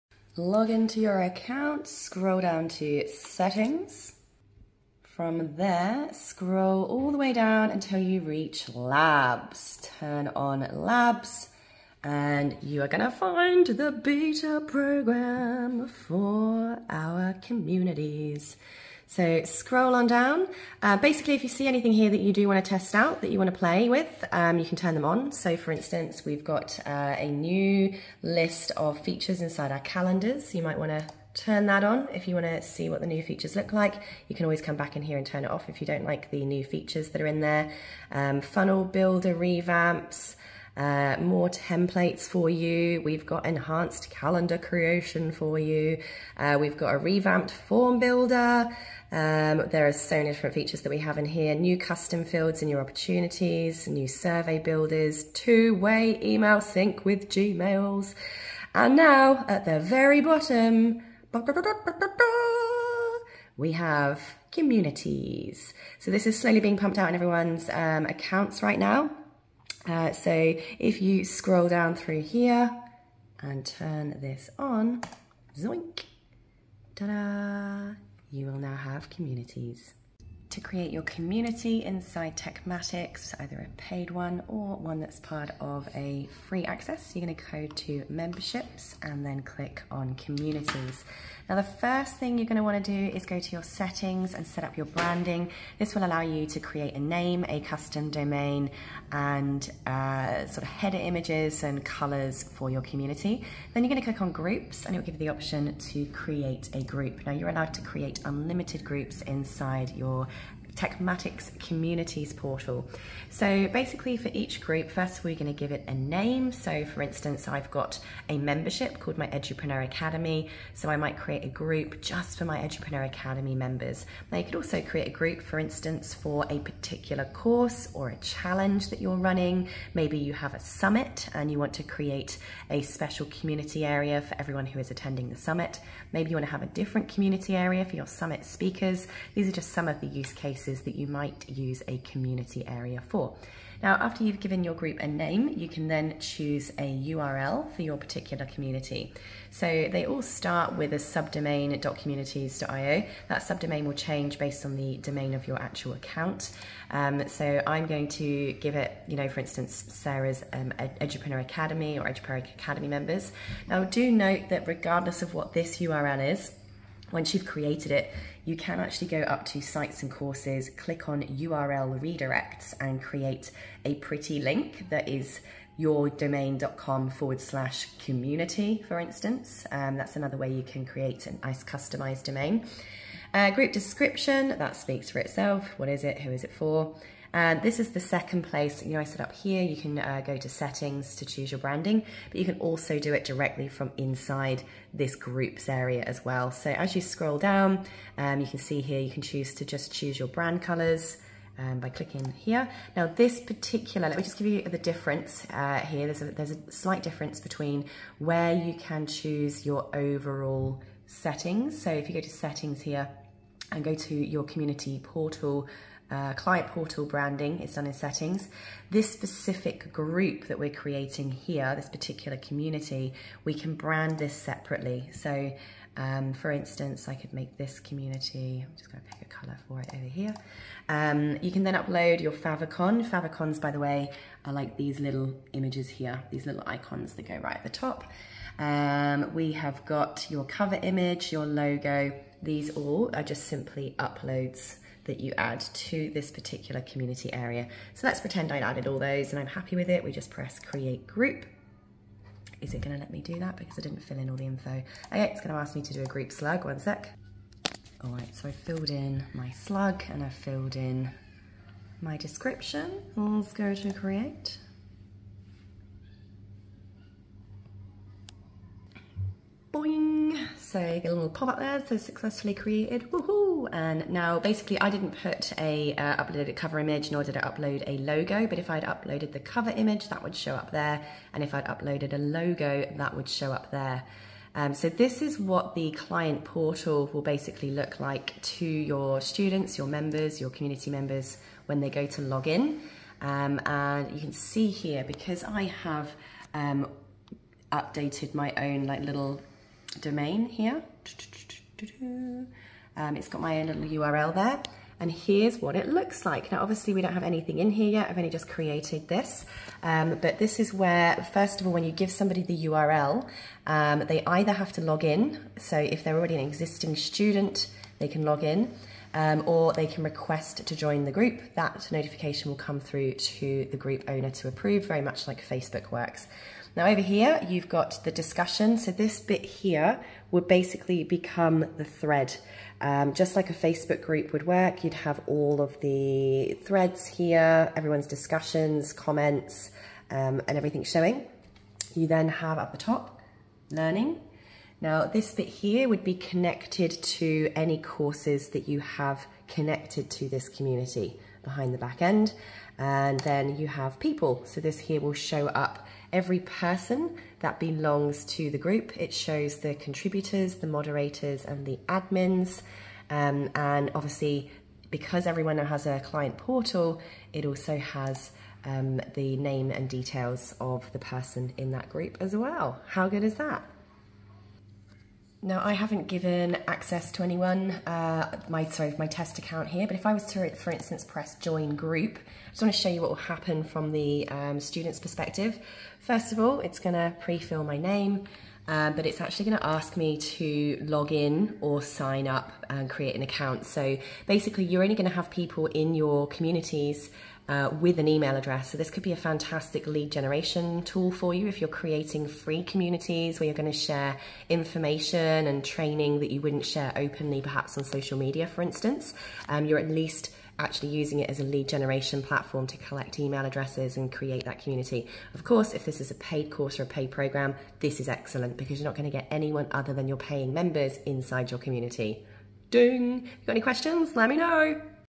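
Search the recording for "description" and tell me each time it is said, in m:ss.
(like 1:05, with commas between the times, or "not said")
3:03, 4:22.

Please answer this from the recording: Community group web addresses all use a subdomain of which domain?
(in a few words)
.communities.io.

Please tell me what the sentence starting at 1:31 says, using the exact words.
Now the first thing you're gonna to want to do is go to your settings and set up your branding.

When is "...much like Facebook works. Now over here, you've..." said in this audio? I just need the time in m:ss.
5:25.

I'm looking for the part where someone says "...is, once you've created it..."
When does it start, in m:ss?
2:46.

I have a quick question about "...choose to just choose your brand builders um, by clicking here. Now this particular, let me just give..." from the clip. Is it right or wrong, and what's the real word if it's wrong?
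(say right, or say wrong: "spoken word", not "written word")
wrong: "colors", not "builders".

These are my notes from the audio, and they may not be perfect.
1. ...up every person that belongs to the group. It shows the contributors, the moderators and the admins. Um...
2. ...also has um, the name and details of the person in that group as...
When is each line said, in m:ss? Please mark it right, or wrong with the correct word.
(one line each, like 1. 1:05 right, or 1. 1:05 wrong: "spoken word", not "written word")
1. 5:55 right
2. 6:07 right.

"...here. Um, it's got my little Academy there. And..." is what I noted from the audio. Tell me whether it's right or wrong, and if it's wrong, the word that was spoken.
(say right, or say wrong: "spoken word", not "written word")
wrong: "URL", not "Academy".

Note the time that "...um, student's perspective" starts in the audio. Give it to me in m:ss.
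6:24.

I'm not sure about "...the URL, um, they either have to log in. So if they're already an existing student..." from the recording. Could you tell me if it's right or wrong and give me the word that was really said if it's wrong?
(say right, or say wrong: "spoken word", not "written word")
right.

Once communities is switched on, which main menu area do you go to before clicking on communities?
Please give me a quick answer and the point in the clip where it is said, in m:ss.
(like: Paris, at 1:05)
Memberships, at 1:28.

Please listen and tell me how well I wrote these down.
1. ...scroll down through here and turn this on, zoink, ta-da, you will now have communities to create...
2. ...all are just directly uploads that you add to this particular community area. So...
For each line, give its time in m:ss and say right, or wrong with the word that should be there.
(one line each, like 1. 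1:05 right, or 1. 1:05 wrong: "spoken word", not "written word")
1. 1:11 right
2. 4:02 wrong: "simply", not "directly".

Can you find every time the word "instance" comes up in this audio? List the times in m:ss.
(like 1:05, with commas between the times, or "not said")
0:25, 1:57, 2:05, 2:39, 2:58, 3:46, 6:20, 6:48.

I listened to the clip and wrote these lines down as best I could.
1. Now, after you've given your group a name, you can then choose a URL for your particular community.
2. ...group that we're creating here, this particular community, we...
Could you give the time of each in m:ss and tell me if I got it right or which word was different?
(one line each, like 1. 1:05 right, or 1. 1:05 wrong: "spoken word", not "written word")
1. 2:23 right
2. 3:39 right.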